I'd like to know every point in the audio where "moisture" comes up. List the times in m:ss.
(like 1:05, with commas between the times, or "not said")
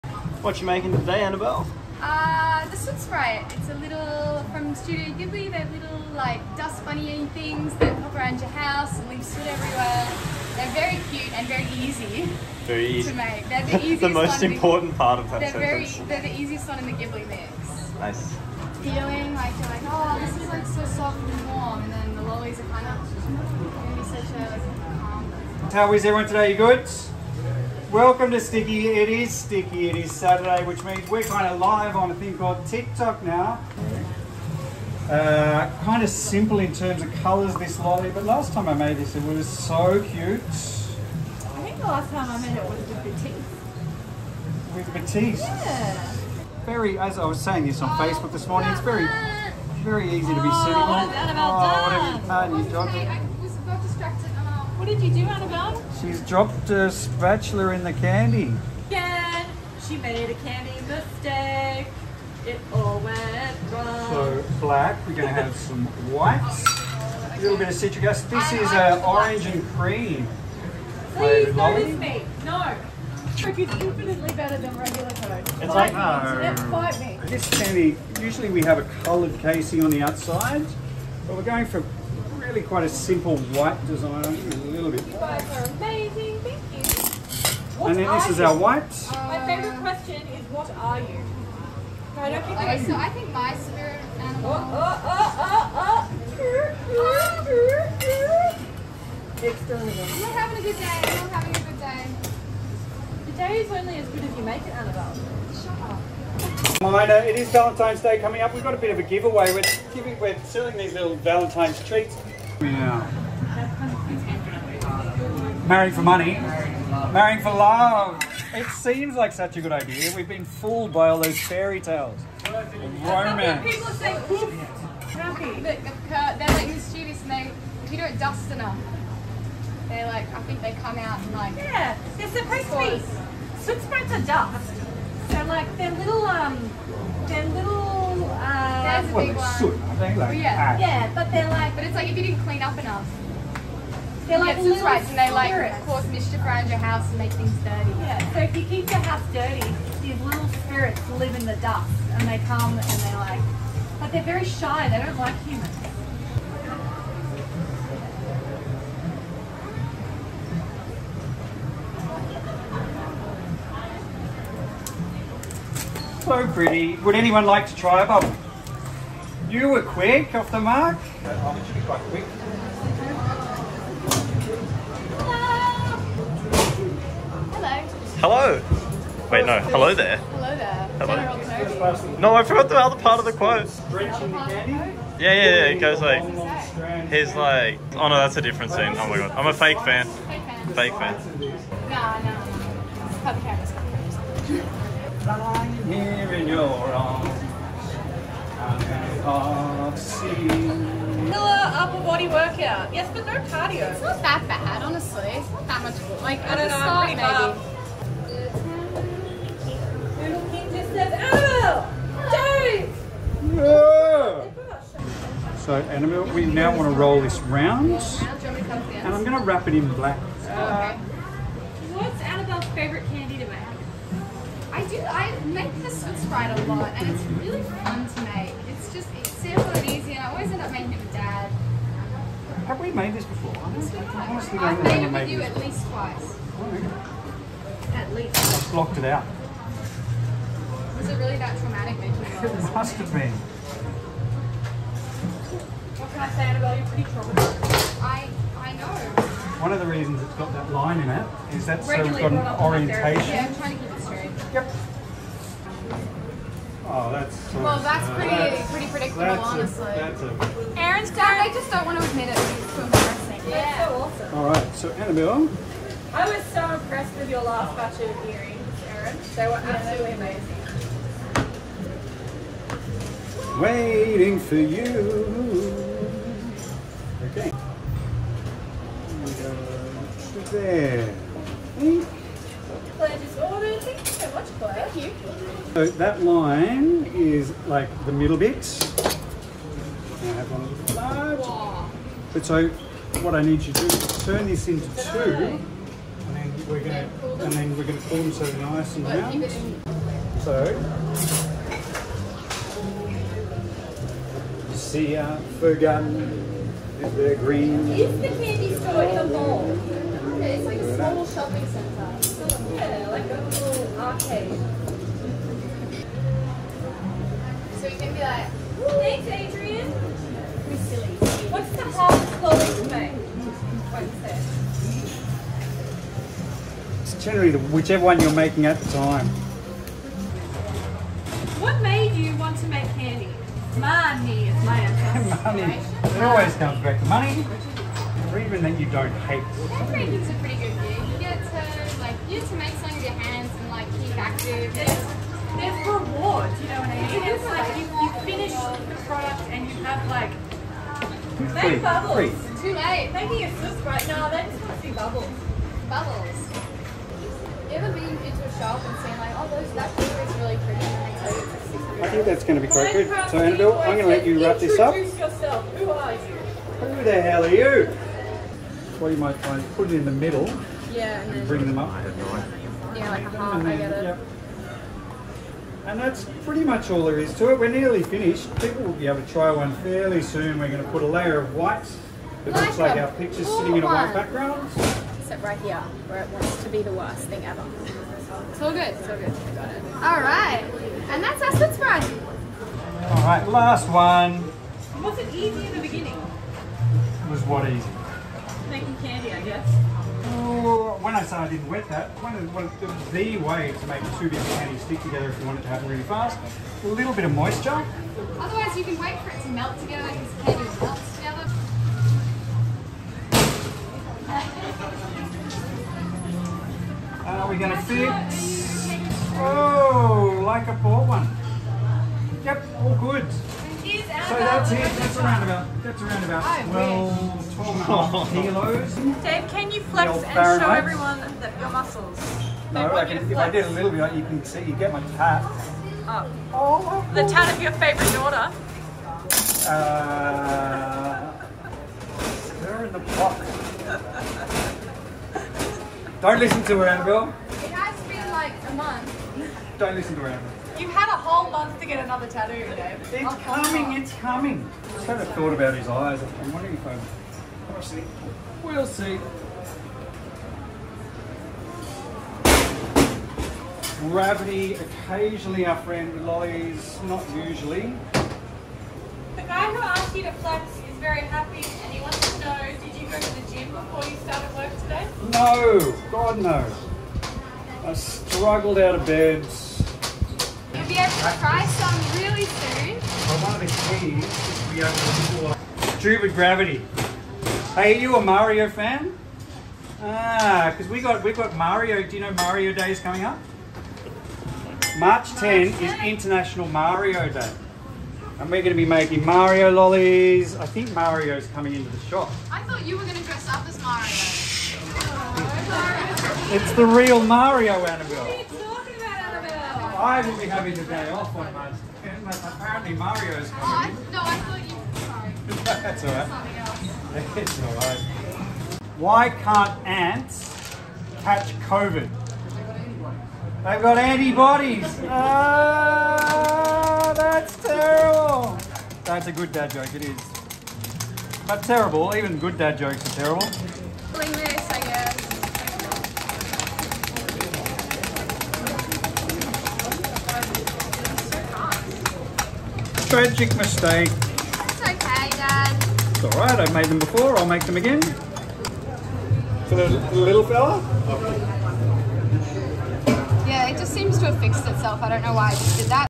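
6:47.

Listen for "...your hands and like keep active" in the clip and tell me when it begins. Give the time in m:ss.
5:43.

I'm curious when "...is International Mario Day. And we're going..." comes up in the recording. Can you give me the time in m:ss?
8:15.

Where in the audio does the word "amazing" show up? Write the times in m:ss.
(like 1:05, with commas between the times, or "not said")
1:25, 4:30.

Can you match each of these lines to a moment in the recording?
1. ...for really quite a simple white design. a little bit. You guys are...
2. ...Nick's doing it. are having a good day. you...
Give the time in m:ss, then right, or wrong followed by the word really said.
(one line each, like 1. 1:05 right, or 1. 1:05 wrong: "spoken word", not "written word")
1. 1:21 right
2. 1:39 right.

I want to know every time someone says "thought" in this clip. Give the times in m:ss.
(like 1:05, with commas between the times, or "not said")
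7:35, 8:22, 8:34.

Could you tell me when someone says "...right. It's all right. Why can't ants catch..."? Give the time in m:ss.
8:37.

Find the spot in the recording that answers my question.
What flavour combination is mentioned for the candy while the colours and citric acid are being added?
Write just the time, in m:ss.
1:09.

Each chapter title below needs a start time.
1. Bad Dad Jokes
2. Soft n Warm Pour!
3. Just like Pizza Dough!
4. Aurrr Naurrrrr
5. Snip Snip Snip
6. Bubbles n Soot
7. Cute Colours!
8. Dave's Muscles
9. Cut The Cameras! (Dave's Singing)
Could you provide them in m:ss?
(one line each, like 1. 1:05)
1. 8:40
2. 0:17
3. 1:27
4. 0:47
5. 1:13
6. 2:10
7. 0:35
8. 7:10
9. 3:11.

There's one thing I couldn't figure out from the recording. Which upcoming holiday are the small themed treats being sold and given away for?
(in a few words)
Valentine's Day.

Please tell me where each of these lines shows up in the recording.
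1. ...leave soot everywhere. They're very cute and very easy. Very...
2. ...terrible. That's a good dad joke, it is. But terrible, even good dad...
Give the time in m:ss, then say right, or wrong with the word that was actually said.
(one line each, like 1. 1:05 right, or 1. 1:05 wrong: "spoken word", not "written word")
1. 0:09 right
2. 8:47 right.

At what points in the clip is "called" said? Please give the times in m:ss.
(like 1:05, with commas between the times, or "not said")
0:32.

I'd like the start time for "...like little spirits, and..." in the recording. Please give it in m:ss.
2:24.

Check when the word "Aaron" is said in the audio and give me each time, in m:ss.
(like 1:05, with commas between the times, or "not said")
4:20, 4:28.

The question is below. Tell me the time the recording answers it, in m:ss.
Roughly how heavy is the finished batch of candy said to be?
7:07.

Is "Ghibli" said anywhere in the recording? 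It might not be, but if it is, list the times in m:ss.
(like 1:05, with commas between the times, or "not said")
0:05, 0:16.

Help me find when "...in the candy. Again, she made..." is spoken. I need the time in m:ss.
0:57.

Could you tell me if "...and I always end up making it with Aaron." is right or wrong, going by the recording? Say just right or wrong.
wrong.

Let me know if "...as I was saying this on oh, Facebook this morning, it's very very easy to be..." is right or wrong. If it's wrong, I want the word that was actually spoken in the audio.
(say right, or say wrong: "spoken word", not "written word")
right.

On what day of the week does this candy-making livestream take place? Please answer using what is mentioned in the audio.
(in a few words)
Saturday.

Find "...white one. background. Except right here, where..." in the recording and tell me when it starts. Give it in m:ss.
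6:23.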